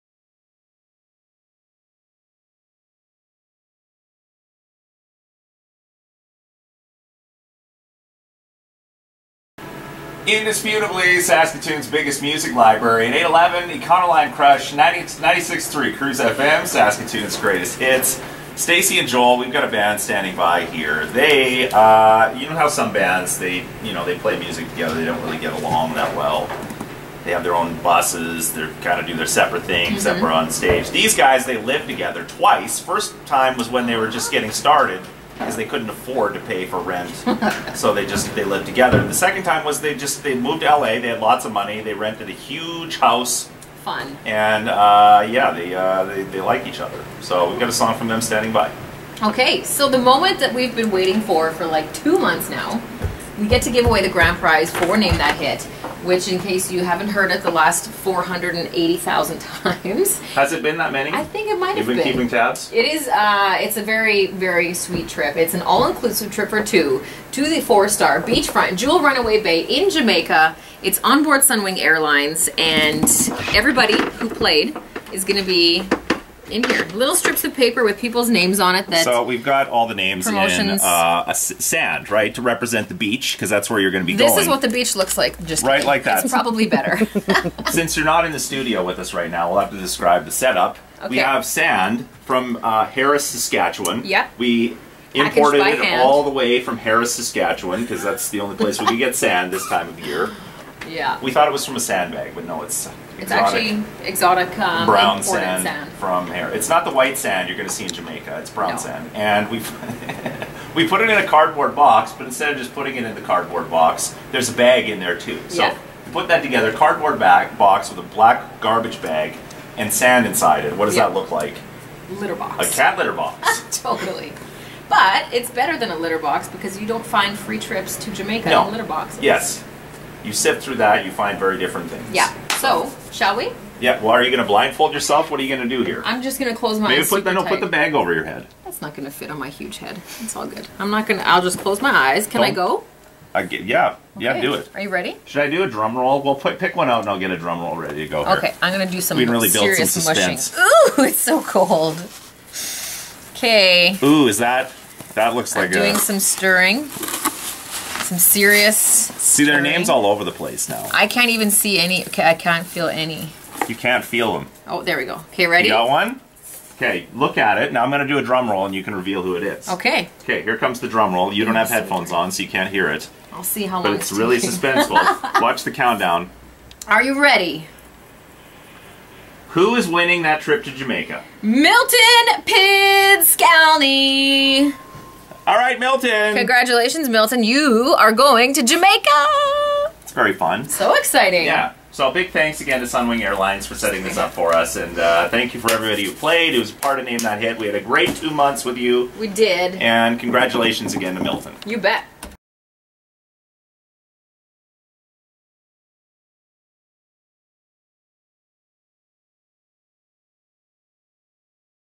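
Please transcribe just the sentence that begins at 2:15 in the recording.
What are you going to do here?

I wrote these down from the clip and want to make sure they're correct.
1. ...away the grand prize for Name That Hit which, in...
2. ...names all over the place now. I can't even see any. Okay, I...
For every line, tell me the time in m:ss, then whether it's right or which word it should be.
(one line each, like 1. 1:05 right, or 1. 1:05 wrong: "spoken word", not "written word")
1. 0:53 right
2. 2:39 right.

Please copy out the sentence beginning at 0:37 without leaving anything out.
so they just they lived together.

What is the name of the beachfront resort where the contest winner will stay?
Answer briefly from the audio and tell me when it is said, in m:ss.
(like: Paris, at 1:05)
Jewel Runaway Bay, at 1:08.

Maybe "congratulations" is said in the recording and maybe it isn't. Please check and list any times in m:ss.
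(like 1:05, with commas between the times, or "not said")
3:06, 3:20.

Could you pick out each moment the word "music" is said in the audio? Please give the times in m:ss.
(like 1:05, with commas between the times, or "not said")
0:12, 0:24.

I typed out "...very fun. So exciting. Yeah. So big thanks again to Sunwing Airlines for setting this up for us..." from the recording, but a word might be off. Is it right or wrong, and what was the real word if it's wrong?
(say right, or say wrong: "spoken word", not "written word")
right.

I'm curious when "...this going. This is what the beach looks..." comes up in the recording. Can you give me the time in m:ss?
1:24.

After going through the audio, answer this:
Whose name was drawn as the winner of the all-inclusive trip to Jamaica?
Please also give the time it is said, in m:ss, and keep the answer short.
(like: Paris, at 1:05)
Milton Pidskalny, at 3:01.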